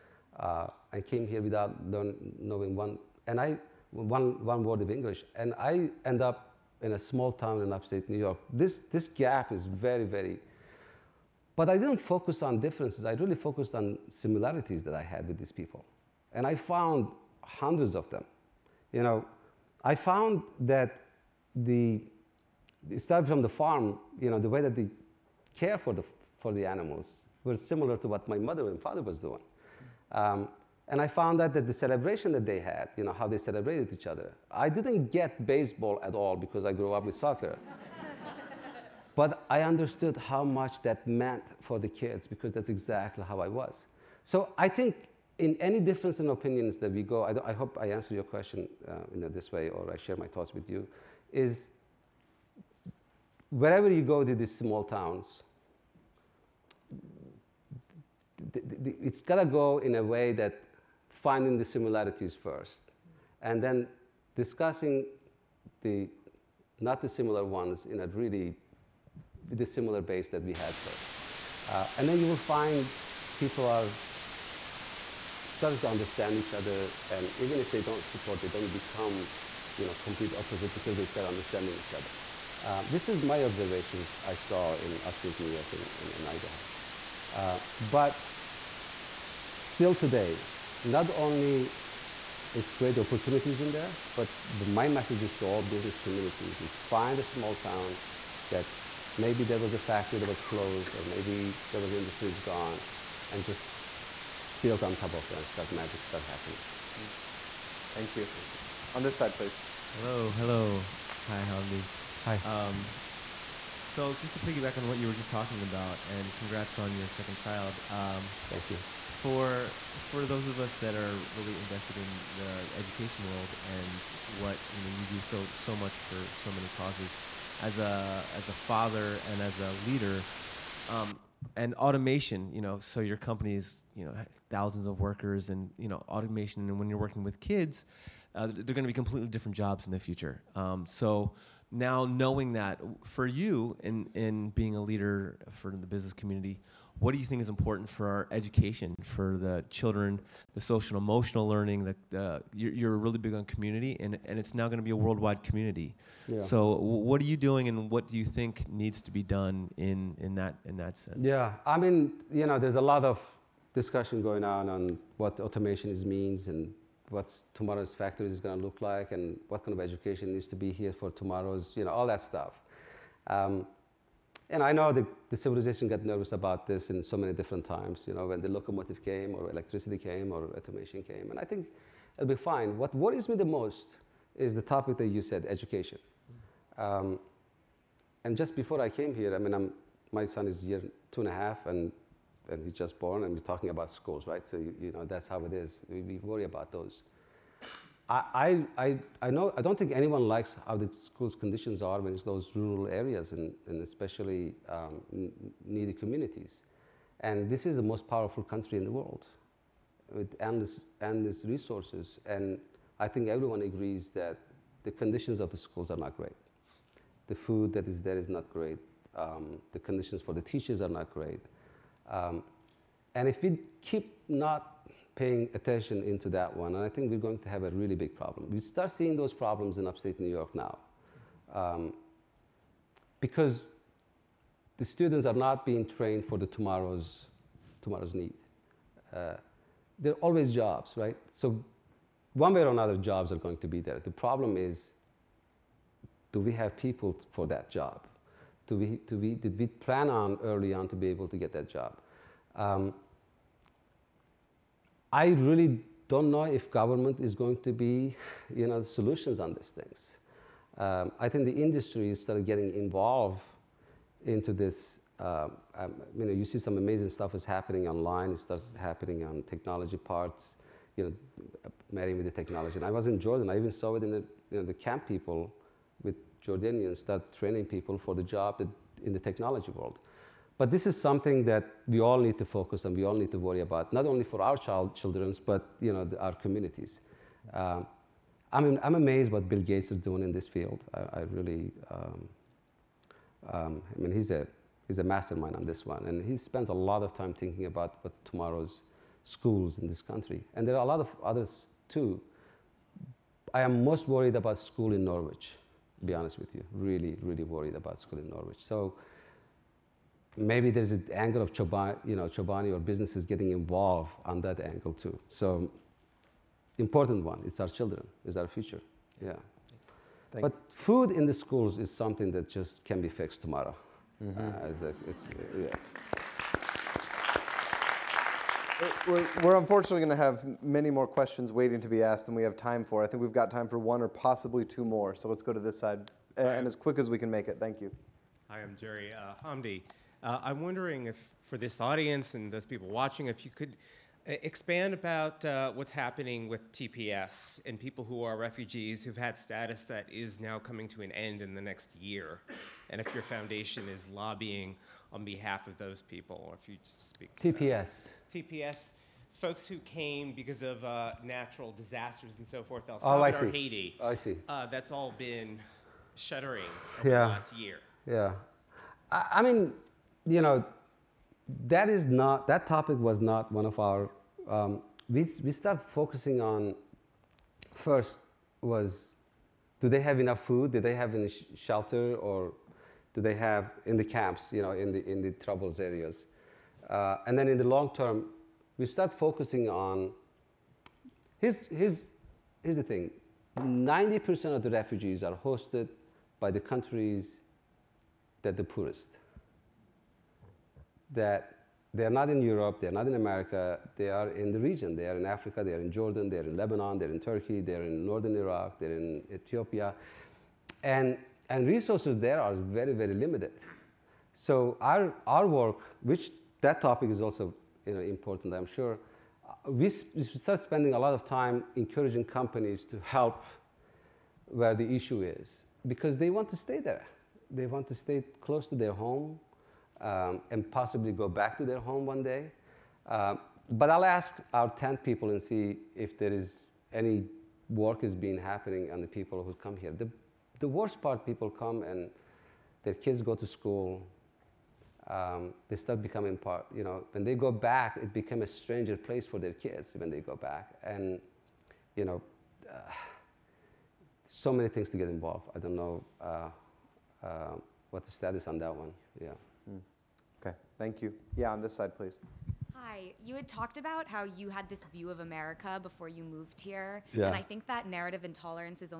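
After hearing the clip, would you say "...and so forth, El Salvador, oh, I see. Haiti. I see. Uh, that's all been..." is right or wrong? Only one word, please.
right.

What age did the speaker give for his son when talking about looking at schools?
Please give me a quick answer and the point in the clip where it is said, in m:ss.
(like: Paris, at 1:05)
2 and a half, at 3:11.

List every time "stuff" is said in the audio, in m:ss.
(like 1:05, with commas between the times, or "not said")
2:52, 4:27.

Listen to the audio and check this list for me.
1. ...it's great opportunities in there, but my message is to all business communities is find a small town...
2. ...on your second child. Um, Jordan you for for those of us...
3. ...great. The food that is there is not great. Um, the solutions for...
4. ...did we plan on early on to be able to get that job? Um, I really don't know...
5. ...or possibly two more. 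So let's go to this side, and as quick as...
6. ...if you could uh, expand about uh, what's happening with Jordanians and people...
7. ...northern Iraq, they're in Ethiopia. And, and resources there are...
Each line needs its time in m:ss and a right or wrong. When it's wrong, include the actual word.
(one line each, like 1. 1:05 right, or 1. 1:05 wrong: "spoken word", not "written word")
1. 1:32 right
2. 1:56 wrong: "Thank", not "Jordan"
3. 3:36 wrong: "conditions", not "solutions"
4. 4:09 right
5. 5:34 right
6. 5:43 wrong: "TPS", not "Jordanians"
7. 6:48 right.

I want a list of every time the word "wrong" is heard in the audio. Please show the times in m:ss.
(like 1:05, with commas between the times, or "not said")
not said.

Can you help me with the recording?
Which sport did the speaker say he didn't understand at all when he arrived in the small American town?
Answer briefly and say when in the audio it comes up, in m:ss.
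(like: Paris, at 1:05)
Baseball, at 0:35.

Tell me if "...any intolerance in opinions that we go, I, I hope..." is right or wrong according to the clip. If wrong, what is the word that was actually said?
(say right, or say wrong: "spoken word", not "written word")
wrong: "difference", not "intolerance".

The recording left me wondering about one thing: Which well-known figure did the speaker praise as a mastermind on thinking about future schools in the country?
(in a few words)
Bill Gates.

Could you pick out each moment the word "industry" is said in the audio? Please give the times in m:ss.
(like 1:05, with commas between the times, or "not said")
1:41, 4:21.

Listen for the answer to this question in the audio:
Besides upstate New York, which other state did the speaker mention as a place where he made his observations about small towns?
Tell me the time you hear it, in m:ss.
1:26.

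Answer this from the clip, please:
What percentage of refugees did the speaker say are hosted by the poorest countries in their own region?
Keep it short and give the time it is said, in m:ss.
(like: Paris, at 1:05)
90%, at 6:33.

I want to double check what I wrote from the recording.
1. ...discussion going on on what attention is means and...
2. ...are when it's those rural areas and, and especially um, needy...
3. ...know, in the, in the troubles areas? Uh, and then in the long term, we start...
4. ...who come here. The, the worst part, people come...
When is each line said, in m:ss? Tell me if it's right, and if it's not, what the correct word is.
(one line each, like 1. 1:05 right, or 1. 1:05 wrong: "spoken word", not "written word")
1. 2:43 wrong: "automation", not "attention"
2. 3:21 right
3. 6:24 right
4. 7:19 right.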